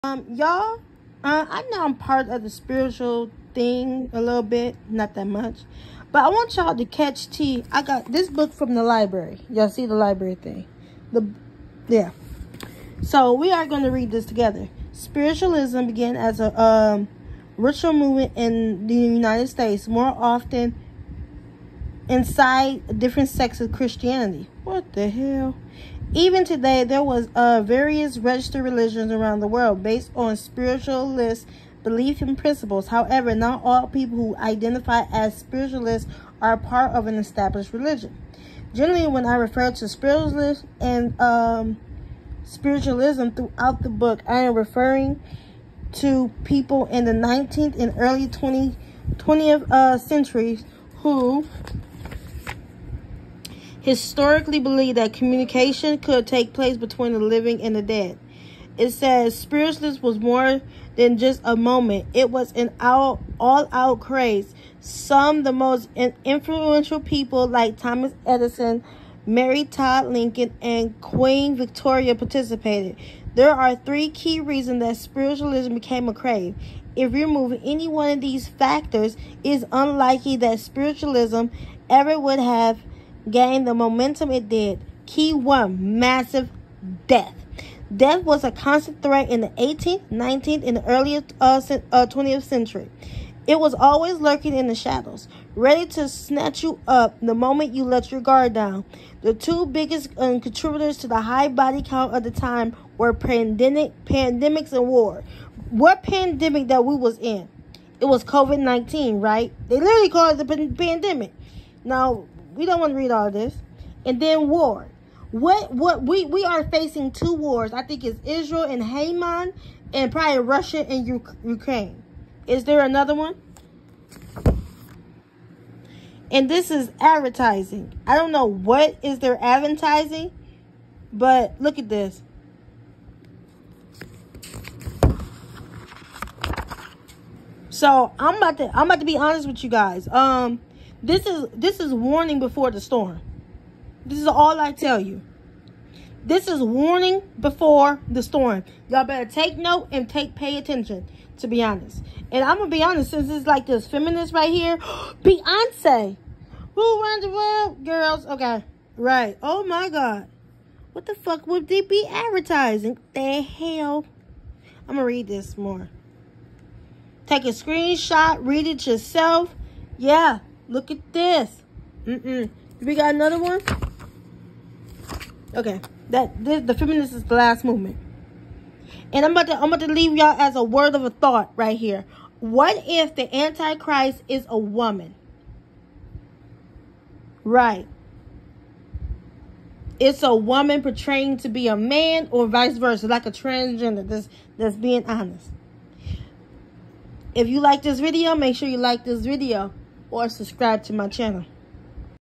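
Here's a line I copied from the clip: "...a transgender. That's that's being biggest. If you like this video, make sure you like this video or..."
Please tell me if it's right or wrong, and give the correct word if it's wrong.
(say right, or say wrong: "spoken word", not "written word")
wrong: "honest", not "biggest".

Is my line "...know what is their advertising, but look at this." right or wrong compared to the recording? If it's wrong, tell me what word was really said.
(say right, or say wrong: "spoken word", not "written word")
right.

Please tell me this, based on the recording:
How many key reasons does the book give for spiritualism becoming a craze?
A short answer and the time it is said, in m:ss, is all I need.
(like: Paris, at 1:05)
3, at 1:13.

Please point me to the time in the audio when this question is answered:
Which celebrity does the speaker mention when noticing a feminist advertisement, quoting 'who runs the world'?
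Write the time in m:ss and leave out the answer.
2:35.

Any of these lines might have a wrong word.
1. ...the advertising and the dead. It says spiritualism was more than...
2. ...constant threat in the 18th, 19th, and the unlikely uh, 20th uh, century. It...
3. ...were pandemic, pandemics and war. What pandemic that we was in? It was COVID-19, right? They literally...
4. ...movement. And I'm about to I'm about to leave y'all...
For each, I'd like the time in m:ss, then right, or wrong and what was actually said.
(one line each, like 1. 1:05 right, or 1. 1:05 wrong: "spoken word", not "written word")
1. 0:57 wrong: "living", not "advertising"
2. 1:28 wrong: "early", not "unlikely"
3. 1:42 right
4. 2:57 right.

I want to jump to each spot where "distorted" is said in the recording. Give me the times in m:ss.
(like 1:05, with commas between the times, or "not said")
not said.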